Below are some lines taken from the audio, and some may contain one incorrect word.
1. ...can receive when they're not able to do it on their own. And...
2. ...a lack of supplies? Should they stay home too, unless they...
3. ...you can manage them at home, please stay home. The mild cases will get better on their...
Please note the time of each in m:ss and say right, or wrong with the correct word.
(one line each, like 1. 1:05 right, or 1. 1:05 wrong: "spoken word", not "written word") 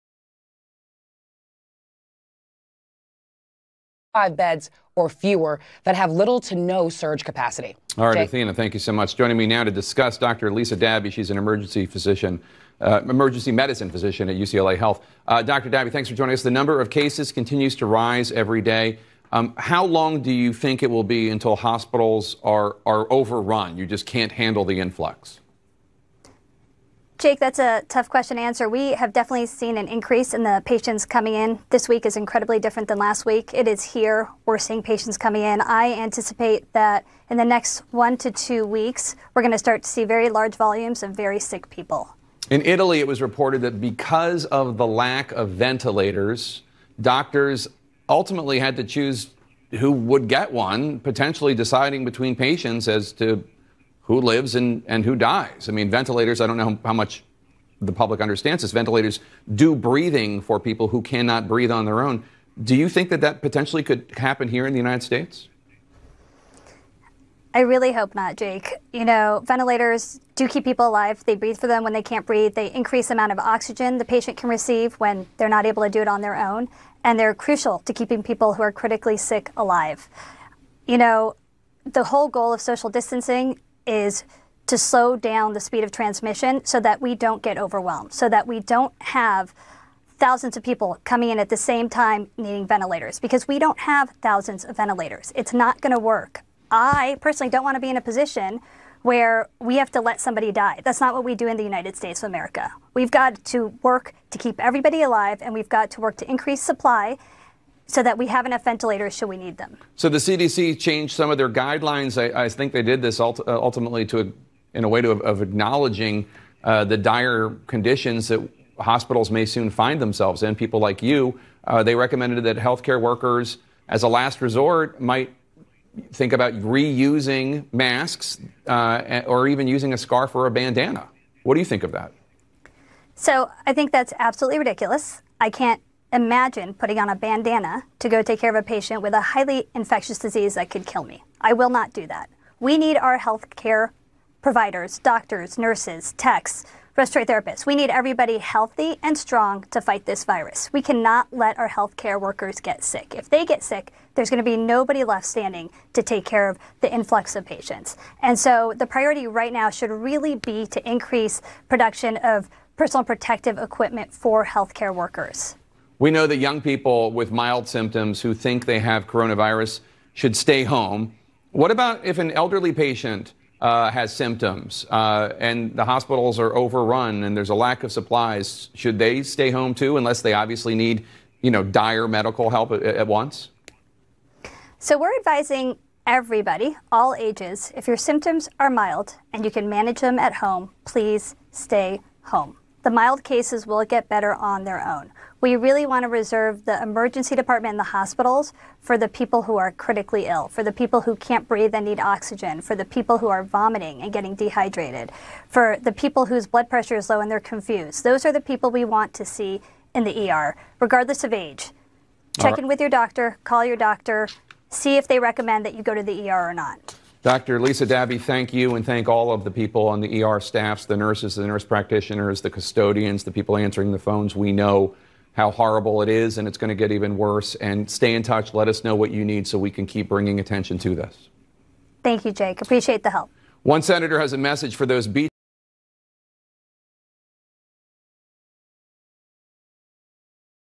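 1. 1:14 right
2. 2:57 right
3. 3:09 right.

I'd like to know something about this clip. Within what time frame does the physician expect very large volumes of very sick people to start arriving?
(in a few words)
1 to 2 weeks.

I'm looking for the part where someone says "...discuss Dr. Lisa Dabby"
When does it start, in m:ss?
0:09.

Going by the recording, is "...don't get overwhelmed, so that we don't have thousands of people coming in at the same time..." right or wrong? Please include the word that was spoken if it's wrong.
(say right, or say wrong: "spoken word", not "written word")
right.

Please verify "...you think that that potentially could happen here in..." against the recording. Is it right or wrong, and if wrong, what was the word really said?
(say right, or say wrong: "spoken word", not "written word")
right.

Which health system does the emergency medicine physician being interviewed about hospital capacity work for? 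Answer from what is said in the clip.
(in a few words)
UCLA Health.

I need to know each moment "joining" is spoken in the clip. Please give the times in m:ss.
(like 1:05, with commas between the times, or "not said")
0:09, 0:16.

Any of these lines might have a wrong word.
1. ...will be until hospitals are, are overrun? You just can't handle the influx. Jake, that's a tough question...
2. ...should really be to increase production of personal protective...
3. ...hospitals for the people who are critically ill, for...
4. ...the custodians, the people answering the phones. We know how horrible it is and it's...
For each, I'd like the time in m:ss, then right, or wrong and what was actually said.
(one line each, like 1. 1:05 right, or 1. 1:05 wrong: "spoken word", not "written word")
1. 0:20 right
2. 2:39 right
3. 3:17 right
4. 3:42 right.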